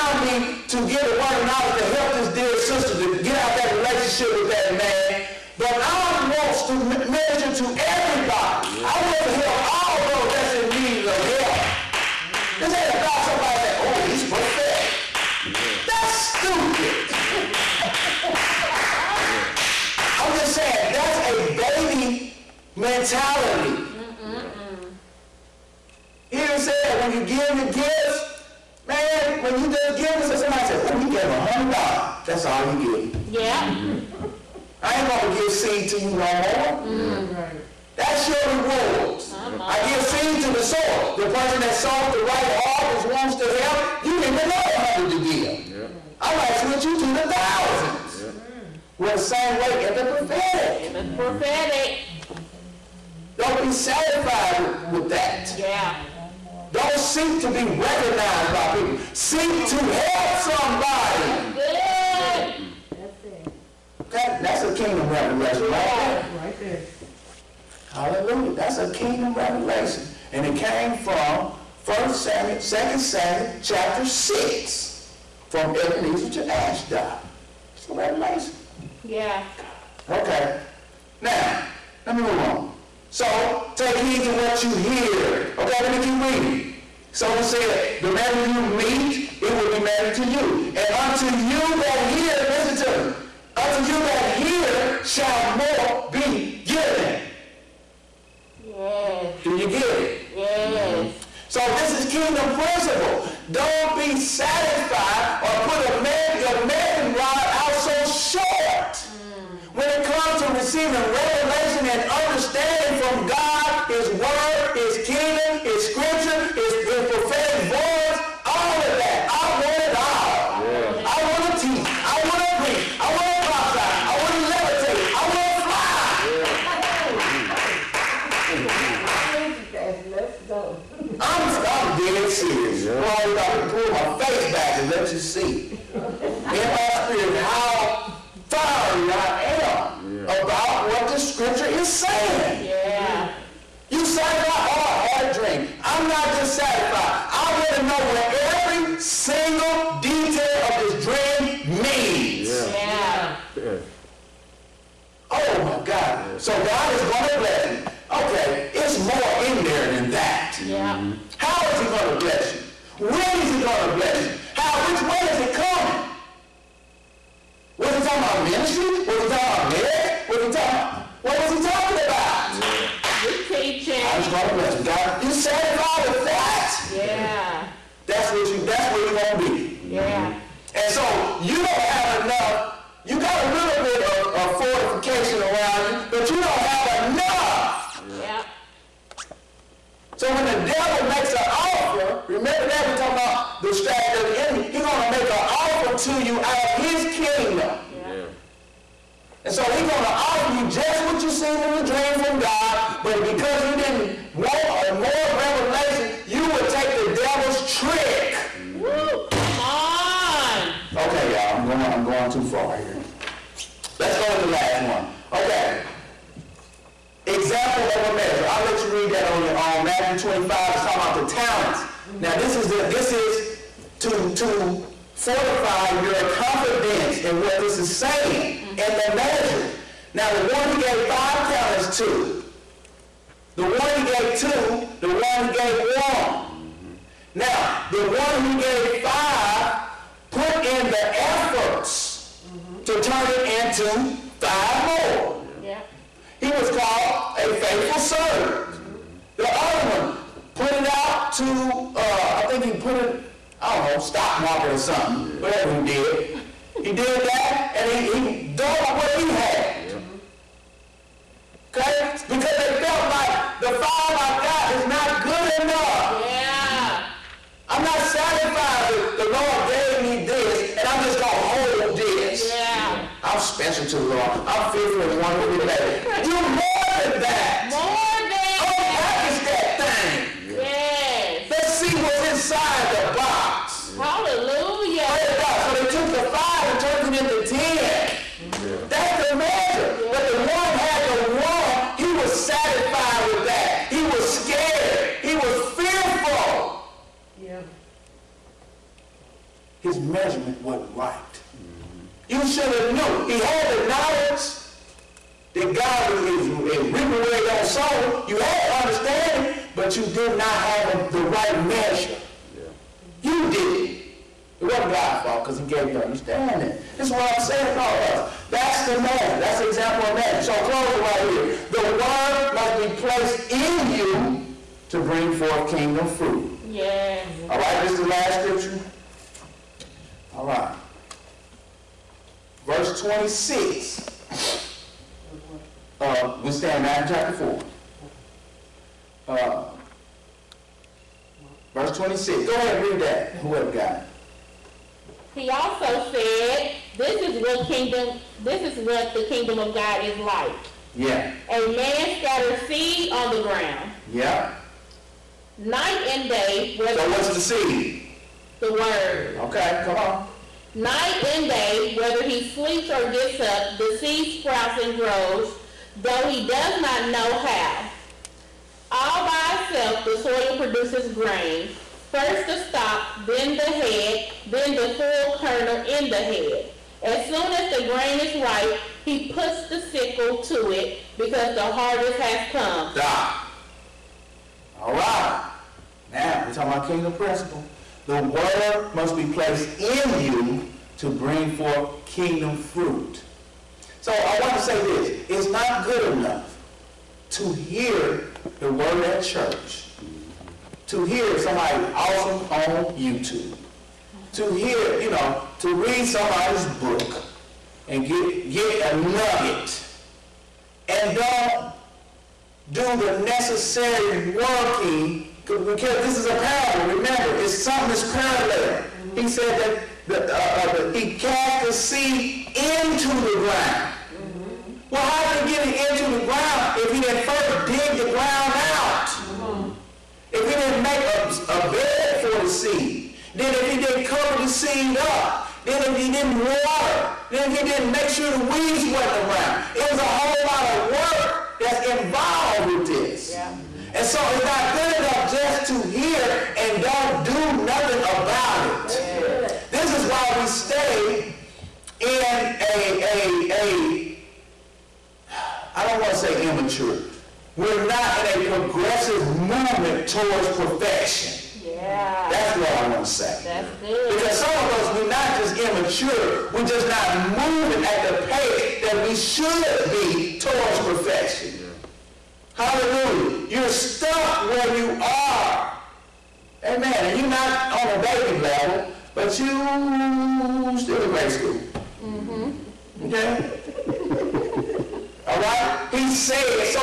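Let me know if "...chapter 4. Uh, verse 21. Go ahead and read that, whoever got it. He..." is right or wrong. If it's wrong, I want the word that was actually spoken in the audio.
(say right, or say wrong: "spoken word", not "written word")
wrong: "26", not "21".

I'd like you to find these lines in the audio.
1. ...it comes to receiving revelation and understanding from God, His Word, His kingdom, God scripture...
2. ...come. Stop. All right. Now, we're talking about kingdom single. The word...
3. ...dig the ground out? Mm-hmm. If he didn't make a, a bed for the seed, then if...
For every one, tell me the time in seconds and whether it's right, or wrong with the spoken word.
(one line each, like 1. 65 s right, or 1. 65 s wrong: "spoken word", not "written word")
1. 109 s wrong: "His", not "God"
2. 382 s wrong: "principle", not "single"
3. 427 s right.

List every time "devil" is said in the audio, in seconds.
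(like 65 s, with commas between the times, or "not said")
190 s, 207 s.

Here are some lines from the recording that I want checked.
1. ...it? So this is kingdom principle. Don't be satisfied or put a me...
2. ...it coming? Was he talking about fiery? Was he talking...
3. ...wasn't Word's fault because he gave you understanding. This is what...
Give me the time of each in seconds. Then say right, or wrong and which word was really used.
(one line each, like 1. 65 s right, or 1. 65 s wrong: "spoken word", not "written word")
1. 100 s right
2. 165 s wrong: "ministry", not "fiery"
3. 314 s wrong: "God", not "Word".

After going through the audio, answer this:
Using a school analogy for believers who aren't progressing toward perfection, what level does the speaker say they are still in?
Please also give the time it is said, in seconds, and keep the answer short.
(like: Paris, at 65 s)
Grade school, at 481 s.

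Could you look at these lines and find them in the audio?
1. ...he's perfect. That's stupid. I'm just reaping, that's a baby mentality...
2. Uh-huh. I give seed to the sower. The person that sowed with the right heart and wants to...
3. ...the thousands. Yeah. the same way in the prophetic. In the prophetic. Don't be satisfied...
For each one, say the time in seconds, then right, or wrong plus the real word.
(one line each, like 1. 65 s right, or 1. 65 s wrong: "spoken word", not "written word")
1. 14 s wrong: "saying", not "reaping"
2. 39 s right
3. 47 s right.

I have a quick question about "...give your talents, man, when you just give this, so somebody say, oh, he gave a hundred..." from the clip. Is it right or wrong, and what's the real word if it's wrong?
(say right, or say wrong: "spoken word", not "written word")
wrong: "gifts", not "talents".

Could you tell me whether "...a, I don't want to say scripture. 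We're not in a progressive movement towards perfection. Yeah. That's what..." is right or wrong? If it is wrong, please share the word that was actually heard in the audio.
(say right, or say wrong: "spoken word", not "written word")
wrong: "immature", not "scripture".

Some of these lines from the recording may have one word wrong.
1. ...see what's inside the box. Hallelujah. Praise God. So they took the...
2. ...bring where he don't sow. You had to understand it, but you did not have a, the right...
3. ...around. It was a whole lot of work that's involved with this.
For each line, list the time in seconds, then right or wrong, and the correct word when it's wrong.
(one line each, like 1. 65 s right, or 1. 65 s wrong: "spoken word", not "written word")
1. 281 s right
2. 306 s wrong: "reaping", not "bring"
3. 439 s right.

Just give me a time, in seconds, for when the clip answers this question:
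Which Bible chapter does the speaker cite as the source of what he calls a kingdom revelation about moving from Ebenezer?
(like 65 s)
72 s.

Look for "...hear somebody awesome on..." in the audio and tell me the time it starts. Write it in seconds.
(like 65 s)
401 s.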